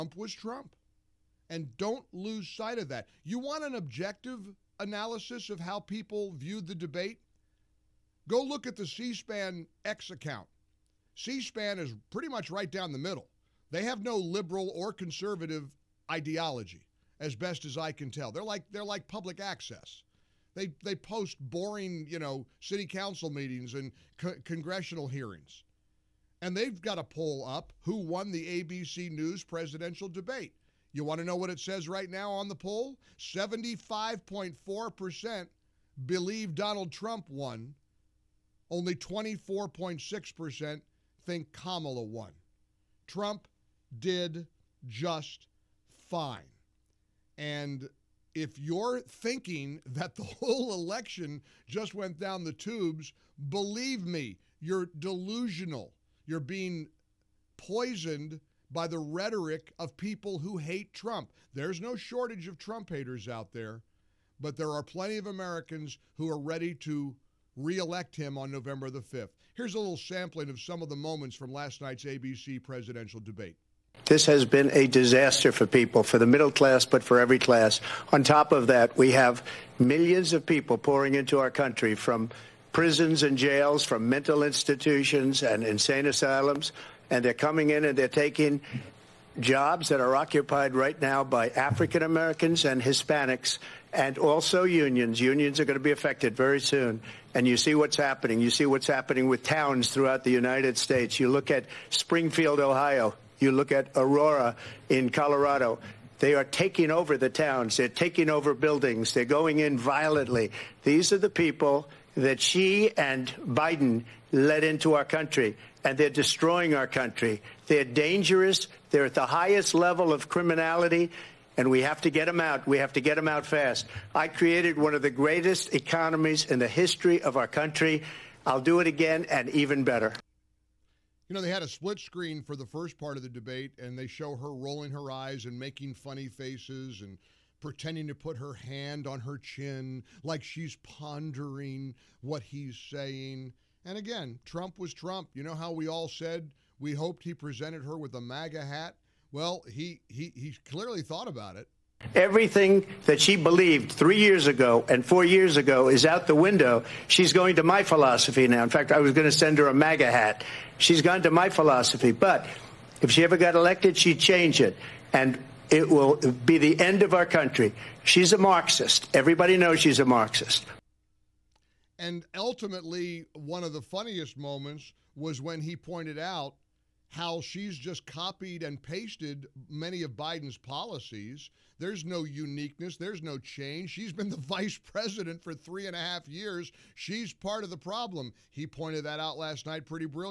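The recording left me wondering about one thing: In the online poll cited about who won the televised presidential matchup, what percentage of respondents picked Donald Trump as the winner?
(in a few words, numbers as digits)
75.4%.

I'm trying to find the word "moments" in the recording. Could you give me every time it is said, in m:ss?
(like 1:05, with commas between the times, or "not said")
1:10, 2:54.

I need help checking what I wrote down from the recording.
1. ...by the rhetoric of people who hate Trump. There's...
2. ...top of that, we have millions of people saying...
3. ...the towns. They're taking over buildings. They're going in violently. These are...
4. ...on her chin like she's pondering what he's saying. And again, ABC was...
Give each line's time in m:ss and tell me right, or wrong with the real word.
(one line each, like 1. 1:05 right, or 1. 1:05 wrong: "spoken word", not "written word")
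1. 0:58 right
2. 1:18 wrong: "pouring", not "saying"
3. 1:47 right
4. 2:19 wrong: "Trump", not "ABC".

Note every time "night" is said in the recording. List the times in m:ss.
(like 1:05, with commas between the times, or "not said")
1:11, 3:09.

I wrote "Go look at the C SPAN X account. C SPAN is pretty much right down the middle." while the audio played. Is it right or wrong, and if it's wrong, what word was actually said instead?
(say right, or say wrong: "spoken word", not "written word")
right.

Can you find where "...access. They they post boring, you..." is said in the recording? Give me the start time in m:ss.
0:19.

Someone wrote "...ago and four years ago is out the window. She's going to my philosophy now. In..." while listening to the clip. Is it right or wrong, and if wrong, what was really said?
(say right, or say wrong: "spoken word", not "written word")
right.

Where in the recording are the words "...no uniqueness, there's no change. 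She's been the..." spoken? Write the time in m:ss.
3:02.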